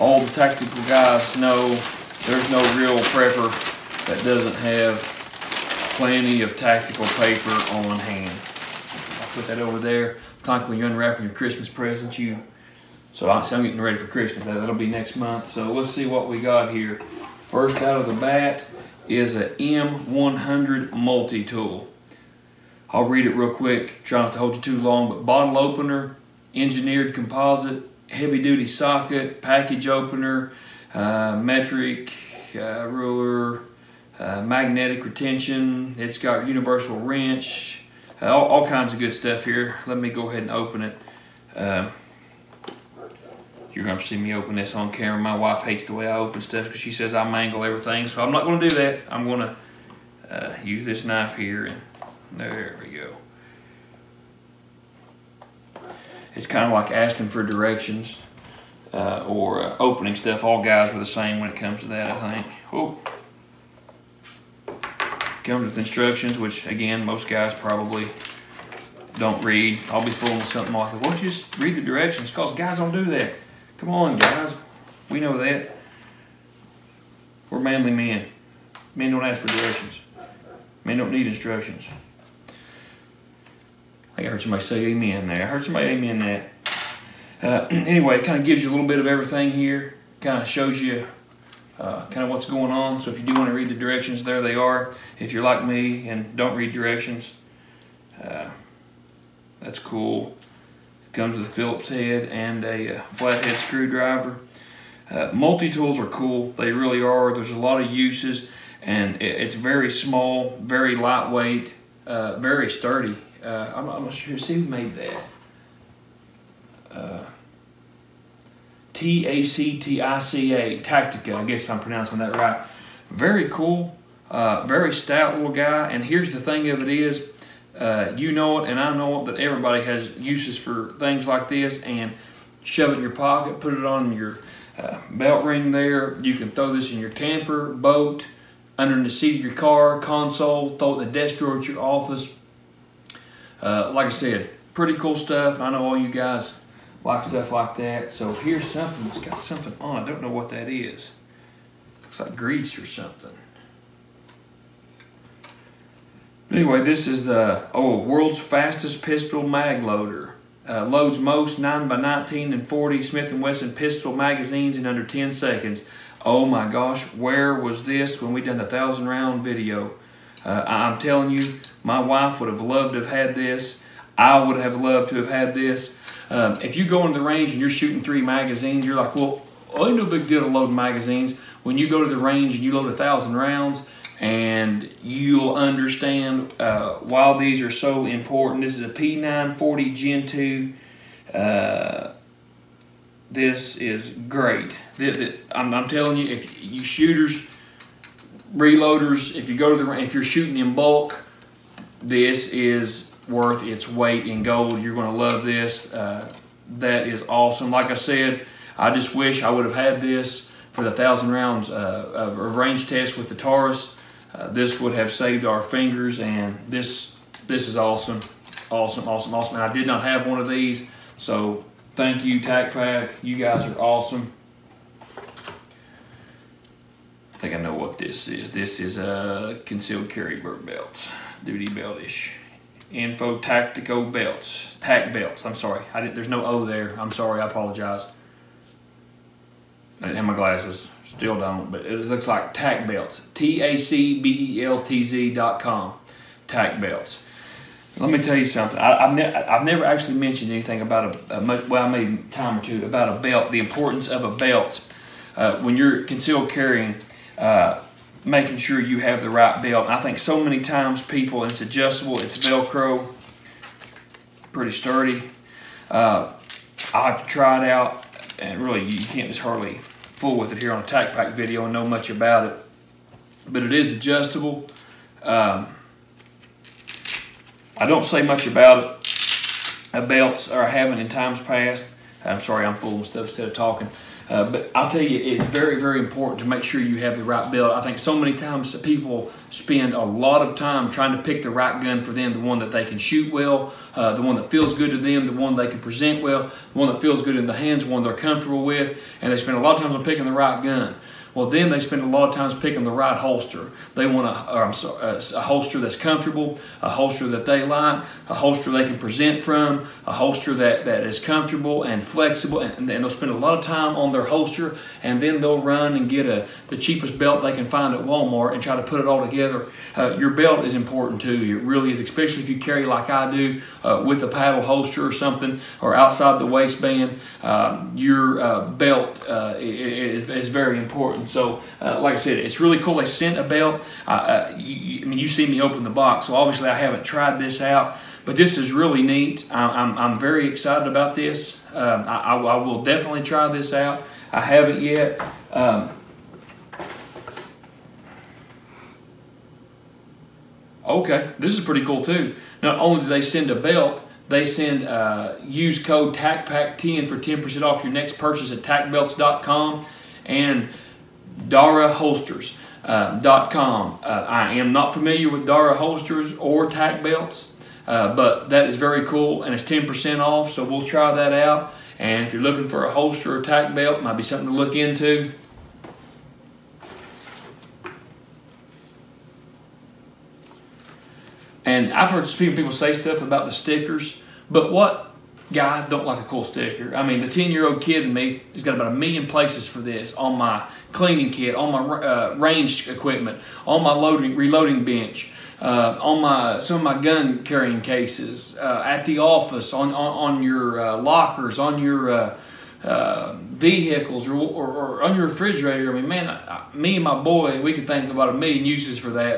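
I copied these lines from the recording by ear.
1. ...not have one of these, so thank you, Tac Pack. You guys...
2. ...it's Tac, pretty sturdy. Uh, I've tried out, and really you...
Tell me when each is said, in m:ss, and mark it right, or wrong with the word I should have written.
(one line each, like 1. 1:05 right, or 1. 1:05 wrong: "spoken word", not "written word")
1. 3:39 right
2. 4:22 wrong: "Velcro", not "Tac".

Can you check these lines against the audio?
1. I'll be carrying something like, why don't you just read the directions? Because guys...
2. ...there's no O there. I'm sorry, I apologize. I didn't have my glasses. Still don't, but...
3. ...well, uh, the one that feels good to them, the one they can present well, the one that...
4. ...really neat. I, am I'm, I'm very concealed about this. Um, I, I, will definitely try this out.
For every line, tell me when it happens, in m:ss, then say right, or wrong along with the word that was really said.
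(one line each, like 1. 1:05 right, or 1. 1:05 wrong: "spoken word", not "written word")
1. 1:09 wrong: "fooling", not "carrying"
2. 3:56 right
3. 4:53 right
4. 5:38 wrong: "excited", not "concealed".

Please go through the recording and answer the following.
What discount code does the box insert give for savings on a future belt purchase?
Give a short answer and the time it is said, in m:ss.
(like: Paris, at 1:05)
tacpack10, at 5:56.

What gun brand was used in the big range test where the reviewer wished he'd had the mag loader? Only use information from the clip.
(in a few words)
Taurus.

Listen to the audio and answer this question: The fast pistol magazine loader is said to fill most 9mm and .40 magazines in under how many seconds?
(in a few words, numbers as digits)
10 seconds.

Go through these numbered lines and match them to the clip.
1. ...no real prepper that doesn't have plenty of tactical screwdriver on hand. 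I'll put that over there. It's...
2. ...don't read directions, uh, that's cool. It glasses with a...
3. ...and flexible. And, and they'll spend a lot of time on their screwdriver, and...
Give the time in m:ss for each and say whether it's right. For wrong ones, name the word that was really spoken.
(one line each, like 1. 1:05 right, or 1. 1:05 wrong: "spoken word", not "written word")
1. 0:02 wrong: "paper", not "screwdriver"
2. 1:36 wrong: "comes", not "glasses"
3. 5:11 wrong: "holster", not "screwdriver".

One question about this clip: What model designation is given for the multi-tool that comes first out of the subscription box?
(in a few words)
M100.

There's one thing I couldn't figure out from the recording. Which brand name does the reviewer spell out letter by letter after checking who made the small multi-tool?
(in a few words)
Tactica.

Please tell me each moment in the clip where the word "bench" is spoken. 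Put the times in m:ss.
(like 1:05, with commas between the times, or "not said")
6:34.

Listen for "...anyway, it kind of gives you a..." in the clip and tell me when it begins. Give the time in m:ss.
1:27.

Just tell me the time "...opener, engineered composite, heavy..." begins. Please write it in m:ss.
0:25.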